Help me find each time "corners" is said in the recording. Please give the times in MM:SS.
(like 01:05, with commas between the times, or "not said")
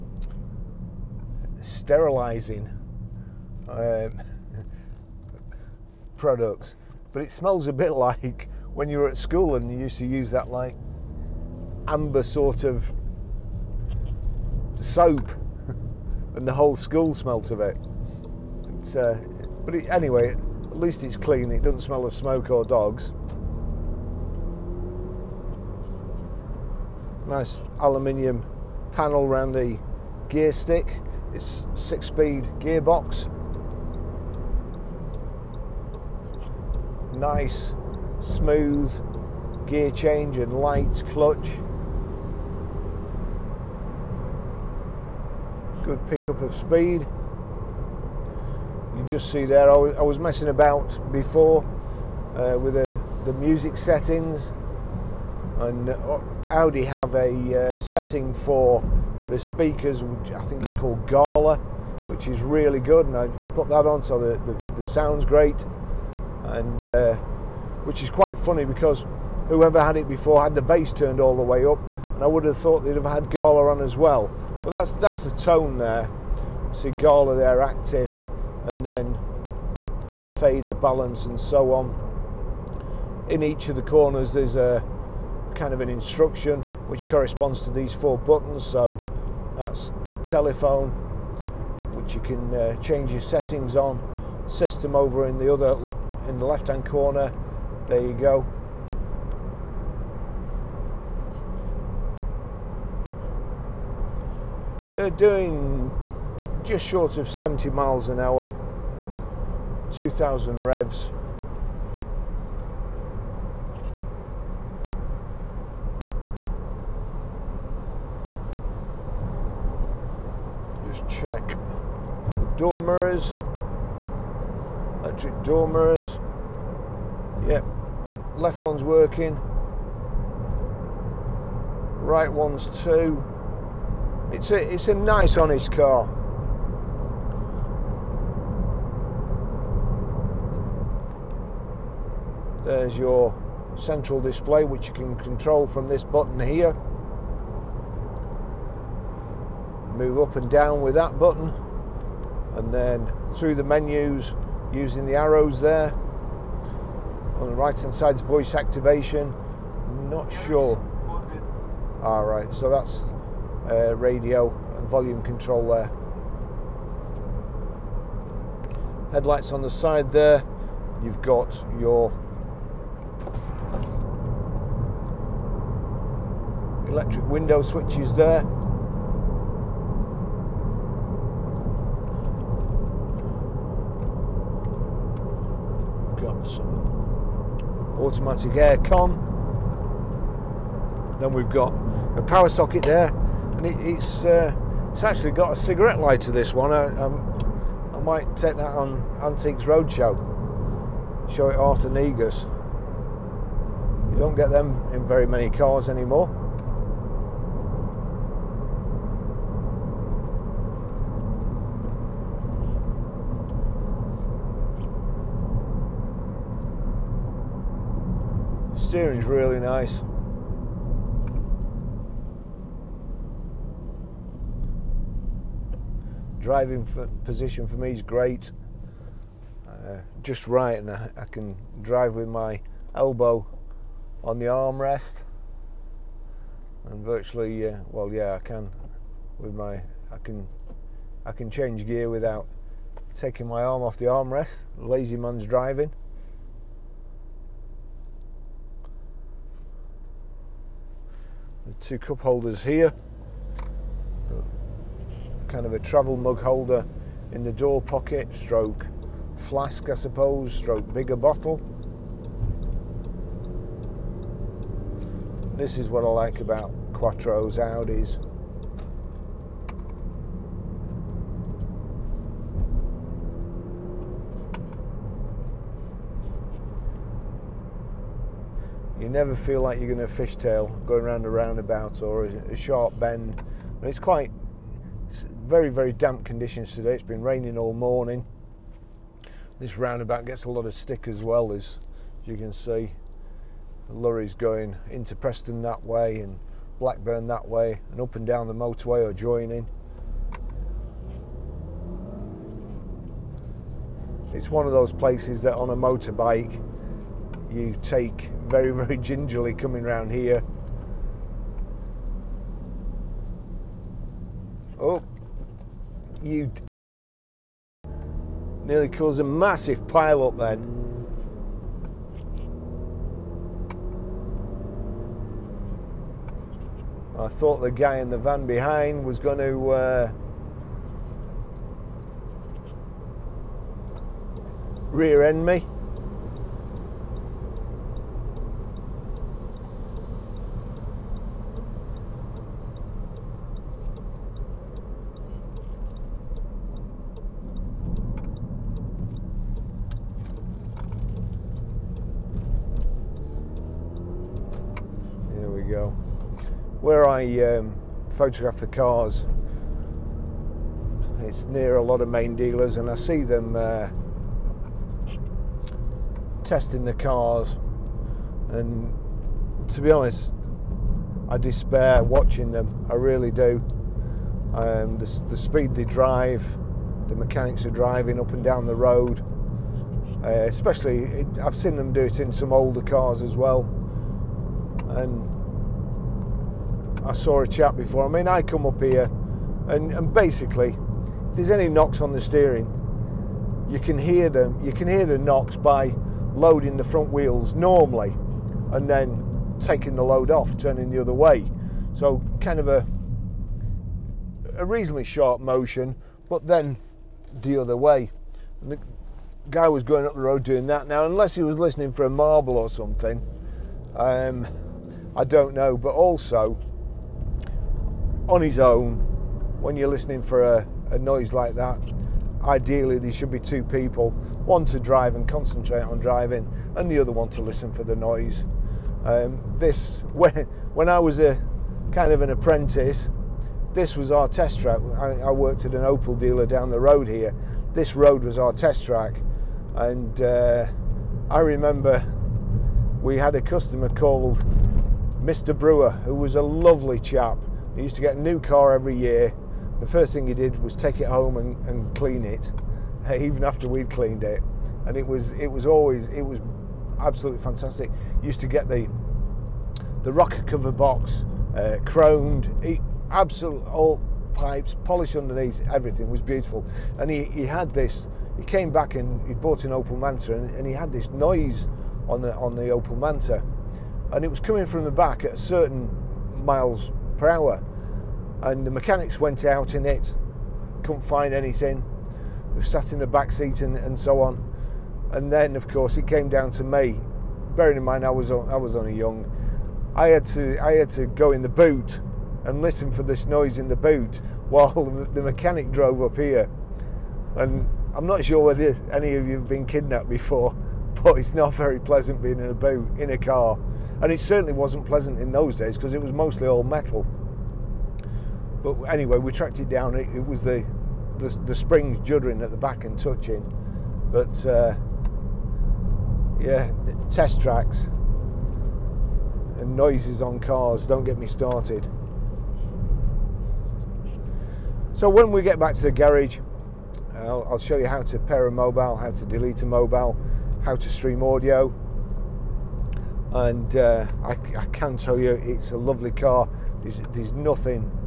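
01:23, 01:36.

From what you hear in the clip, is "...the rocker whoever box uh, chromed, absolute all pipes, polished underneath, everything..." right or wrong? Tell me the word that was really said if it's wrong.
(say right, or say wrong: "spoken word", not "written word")
wrong: "cover", not "whoever".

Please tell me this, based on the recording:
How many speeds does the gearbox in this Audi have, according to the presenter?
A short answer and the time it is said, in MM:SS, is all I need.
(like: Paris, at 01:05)
6, at 00:31.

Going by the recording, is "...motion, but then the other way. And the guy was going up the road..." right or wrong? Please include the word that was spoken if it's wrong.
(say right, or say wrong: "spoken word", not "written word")
right.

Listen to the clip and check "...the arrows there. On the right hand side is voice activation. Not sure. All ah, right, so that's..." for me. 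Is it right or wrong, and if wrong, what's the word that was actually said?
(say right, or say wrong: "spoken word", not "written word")
right.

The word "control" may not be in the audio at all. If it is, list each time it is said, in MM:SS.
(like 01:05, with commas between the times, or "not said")
02:25, 02:45.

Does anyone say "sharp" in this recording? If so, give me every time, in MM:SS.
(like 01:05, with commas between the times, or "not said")
04:42, 06:45.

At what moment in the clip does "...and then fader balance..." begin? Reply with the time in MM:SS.
01:18.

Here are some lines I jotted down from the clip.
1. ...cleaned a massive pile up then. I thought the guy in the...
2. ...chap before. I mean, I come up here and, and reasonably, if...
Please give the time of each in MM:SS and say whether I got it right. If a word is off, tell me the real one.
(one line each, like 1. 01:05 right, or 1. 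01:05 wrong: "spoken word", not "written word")
1. 05:18 wrong: "caused", not "cleaned"
2. 06:27 wrong: "basically", not "reasonably".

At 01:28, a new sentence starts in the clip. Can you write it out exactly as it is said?
So that's telephone, which you can uh, change your settings on.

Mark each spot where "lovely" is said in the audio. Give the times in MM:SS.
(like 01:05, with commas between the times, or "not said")
07:26, 08:55.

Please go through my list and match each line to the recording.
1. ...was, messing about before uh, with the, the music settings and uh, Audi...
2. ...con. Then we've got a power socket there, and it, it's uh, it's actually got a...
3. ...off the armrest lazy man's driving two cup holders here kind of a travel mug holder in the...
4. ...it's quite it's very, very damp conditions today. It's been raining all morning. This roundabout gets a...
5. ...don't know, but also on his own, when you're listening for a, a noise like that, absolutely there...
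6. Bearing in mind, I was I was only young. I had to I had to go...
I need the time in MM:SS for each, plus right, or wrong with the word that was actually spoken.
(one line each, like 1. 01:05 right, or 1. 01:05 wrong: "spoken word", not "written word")
1. 00:50 right
2. 03:08 right
3. 04:03 right
4. 04:43 right
5. 06:55 wrong: "ideally", not "absolutely"
6. 08:07 right.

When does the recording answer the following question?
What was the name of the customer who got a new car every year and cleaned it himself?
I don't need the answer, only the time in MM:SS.
07:25.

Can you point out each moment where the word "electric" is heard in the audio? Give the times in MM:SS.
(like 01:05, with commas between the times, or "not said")
02:05, 02:56.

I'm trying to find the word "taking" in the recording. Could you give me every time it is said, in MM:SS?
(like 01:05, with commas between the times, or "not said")
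04:03, 06:39.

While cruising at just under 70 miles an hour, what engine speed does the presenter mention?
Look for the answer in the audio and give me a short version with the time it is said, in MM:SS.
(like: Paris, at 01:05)
2000 revs, at 01:49.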